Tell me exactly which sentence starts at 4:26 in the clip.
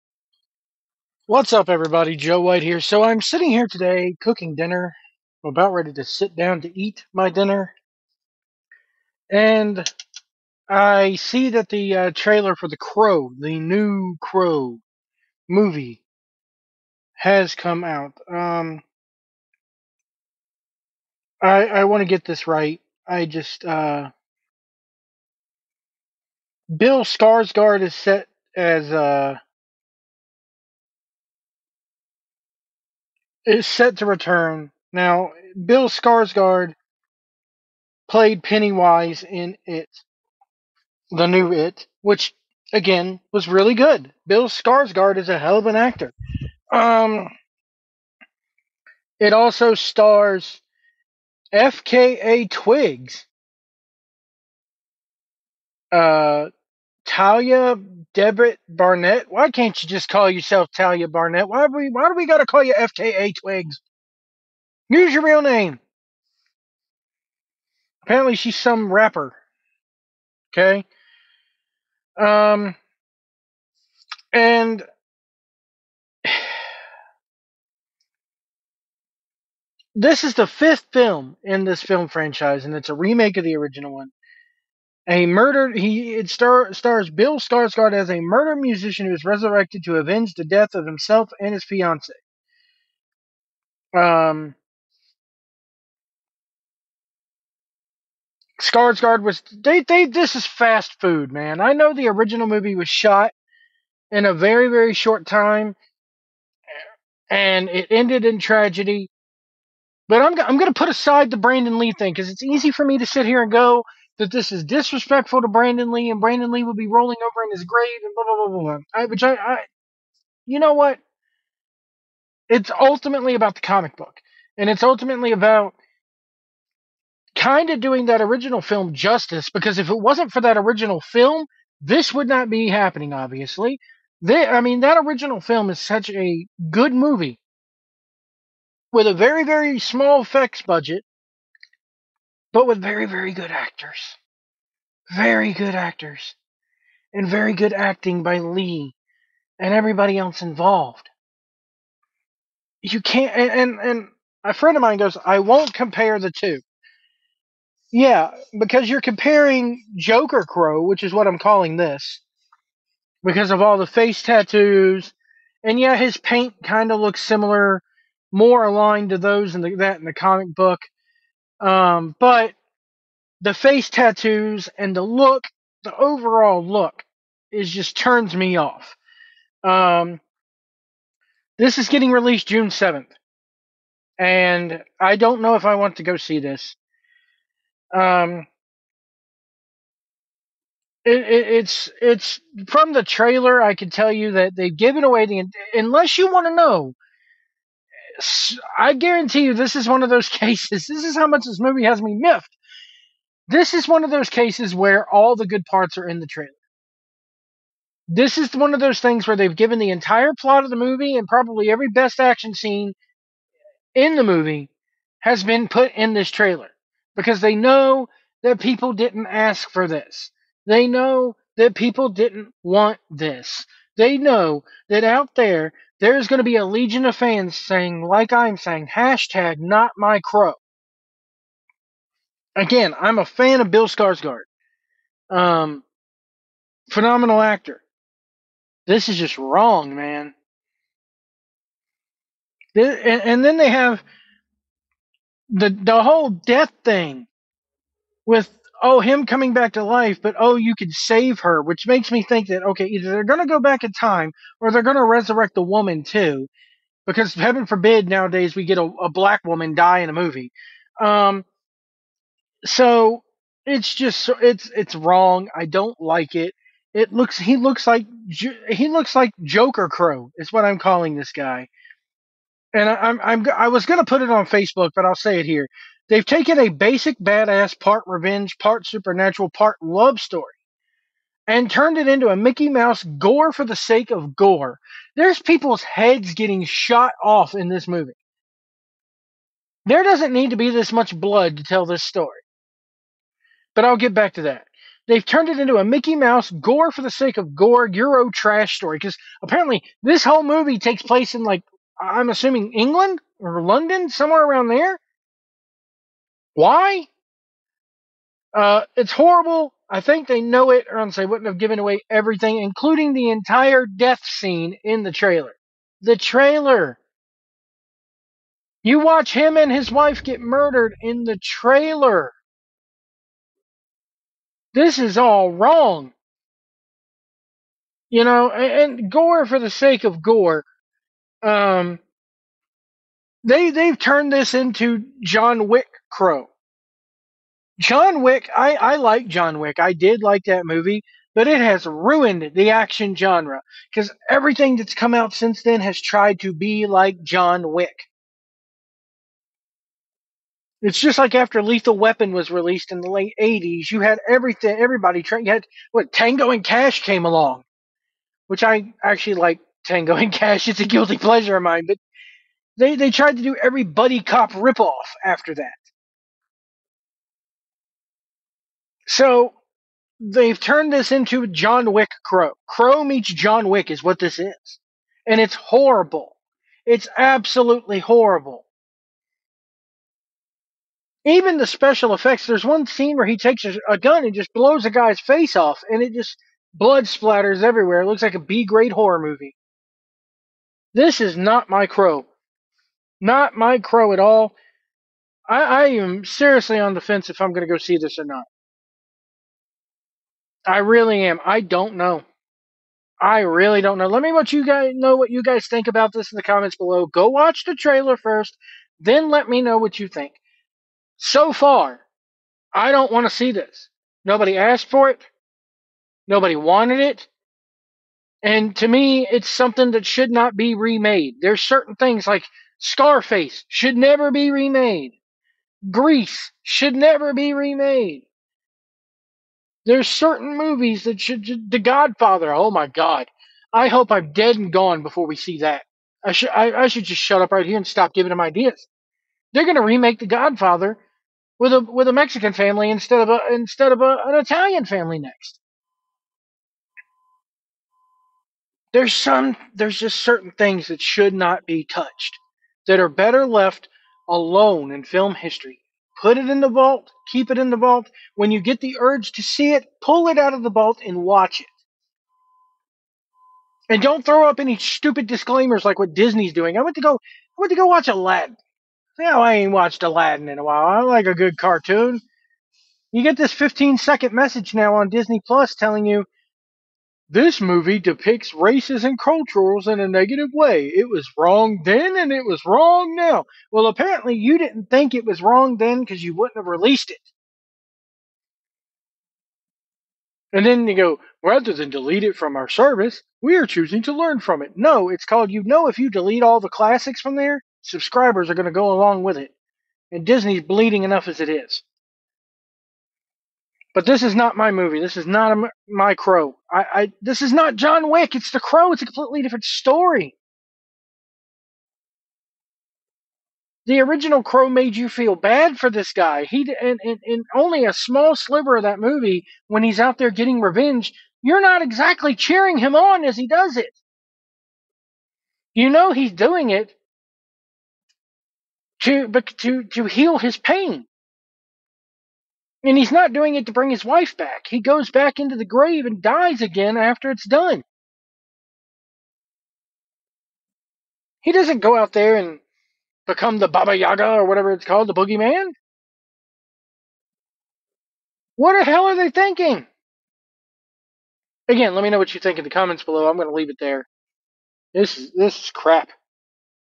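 It looks he looks like he looks like Joker Crow is what I'm calling this guy.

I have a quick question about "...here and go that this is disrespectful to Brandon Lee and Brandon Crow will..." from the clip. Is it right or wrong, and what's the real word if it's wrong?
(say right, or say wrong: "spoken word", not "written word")
wrong: "Lee", not "Crow".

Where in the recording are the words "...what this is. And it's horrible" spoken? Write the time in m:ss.
6:14.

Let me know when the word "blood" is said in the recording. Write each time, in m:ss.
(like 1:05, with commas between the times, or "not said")
4:51, 6:26.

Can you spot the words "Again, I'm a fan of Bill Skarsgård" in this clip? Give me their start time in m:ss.
3:52.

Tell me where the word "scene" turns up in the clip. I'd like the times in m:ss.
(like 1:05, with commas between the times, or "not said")
3:32, 5:14, 6:22.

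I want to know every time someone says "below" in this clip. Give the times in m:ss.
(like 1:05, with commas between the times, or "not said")
6:46, 9:13.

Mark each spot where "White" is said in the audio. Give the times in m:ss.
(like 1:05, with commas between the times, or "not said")
0:02.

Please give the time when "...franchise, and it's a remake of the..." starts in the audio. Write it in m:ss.
1:22.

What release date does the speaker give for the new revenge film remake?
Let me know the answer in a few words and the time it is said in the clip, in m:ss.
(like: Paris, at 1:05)
June 7th, at 3:02.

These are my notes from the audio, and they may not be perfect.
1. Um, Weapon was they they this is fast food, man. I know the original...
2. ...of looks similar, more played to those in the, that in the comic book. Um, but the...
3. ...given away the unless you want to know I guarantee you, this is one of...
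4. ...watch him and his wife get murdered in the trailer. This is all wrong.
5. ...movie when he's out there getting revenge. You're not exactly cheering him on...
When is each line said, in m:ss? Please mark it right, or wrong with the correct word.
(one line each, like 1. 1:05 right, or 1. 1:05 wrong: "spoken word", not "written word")
1. 1:33 wrong: "Skarsgård", not "Weapon"
2. 2:46 wrong: "aligned", not "played"
3. 3:14 right
4. 5:18 right
5. 8:38 right.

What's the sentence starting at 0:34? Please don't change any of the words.
Now, Bill Skarsgård played Pennywise in It, the new It, which again was really good.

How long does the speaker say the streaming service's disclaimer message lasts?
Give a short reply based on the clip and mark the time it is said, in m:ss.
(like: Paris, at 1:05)
15 seconds, at 7:53.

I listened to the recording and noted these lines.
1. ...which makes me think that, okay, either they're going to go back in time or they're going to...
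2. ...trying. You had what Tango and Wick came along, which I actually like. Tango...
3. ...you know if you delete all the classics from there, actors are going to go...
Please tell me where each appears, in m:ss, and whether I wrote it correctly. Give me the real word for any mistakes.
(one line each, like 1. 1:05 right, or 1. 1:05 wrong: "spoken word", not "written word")
1. 4:11 right
2. 5:55 wrong: "Cash", not "Wick"
3. 8:15 wrong: "subscribers", not "actors".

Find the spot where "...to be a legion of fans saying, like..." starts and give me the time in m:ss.
3:46.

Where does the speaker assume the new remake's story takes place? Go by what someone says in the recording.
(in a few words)
England.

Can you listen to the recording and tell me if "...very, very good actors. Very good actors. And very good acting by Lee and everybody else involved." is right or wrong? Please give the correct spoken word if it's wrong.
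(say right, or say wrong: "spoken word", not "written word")
right.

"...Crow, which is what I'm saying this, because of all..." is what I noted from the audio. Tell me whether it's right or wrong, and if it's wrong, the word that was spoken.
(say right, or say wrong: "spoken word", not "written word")
wrong: "calling", not "saying".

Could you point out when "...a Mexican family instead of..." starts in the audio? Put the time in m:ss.
7:22.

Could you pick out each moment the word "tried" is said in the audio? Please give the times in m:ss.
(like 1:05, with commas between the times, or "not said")
5:45, 6:03.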